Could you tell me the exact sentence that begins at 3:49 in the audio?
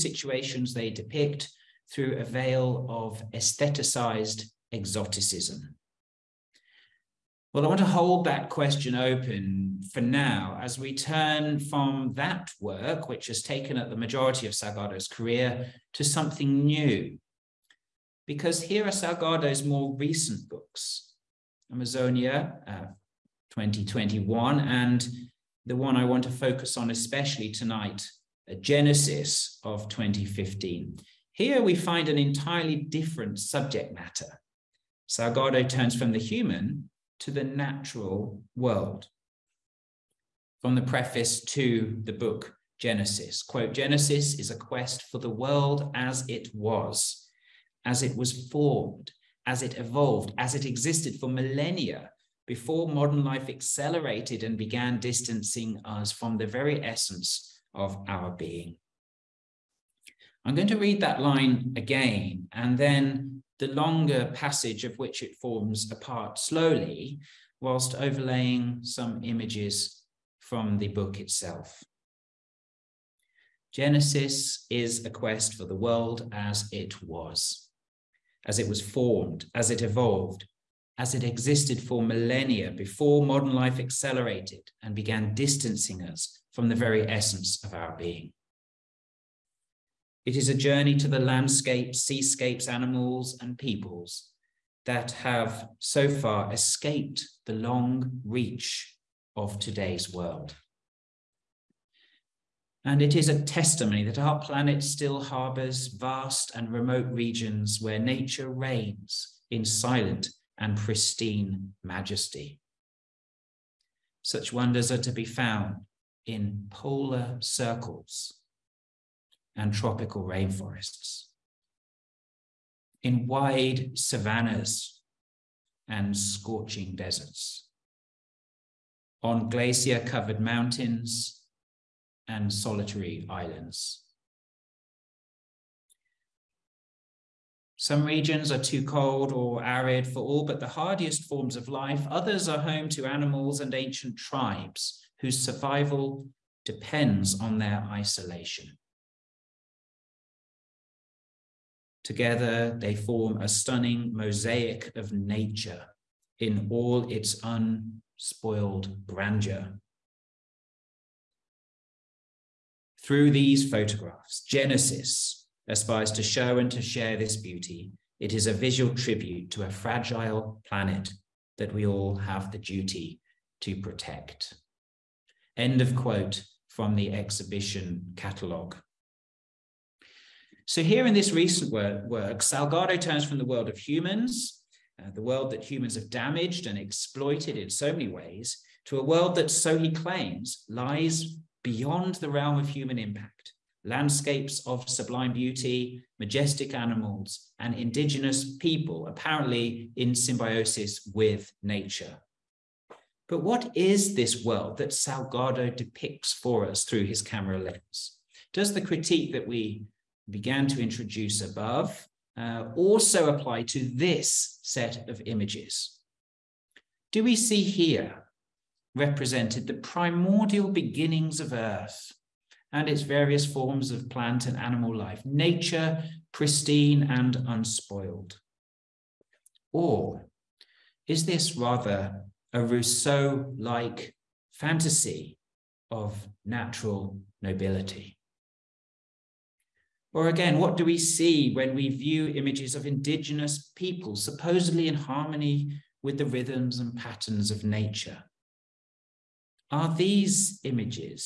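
Or is this rather a Rousseau like fantasy of natural nobility?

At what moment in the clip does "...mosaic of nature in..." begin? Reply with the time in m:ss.
2:34.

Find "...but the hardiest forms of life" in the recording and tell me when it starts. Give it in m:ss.
2:20.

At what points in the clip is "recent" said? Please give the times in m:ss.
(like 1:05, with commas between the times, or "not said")
0:19, 3:01.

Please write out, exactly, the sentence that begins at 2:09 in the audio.
On glacier covered mountains and solitary islands.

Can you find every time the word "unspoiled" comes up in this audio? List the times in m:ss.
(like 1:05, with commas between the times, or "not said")
2:37, 3:47.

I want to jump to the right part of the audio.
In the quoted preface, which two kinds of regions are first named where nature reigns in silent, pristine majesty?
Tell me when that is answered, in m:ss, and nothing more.
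1:56.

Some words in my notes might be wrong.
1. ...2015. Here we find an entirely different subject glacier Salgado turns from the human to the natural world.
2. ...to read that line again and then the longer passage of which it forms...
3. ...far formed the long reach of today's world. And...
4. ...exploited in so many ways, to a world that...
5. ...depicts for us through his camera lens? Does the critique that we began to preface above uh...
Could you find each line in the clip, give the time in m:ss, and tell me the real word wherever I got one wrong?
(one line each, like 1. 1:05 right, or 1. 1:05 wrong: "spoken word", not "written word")
1. 0:29 wrong: "matter", not "glacier"
2. 1:00 right
3. 1:36 wrong: "escaped", not "formed"
4. 3:06 right
5. 3:25 wrong: "introduce", not "preface".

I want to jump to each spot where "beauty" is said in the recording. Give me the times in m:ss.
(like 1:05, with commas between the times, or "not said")
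2:47, 3:15.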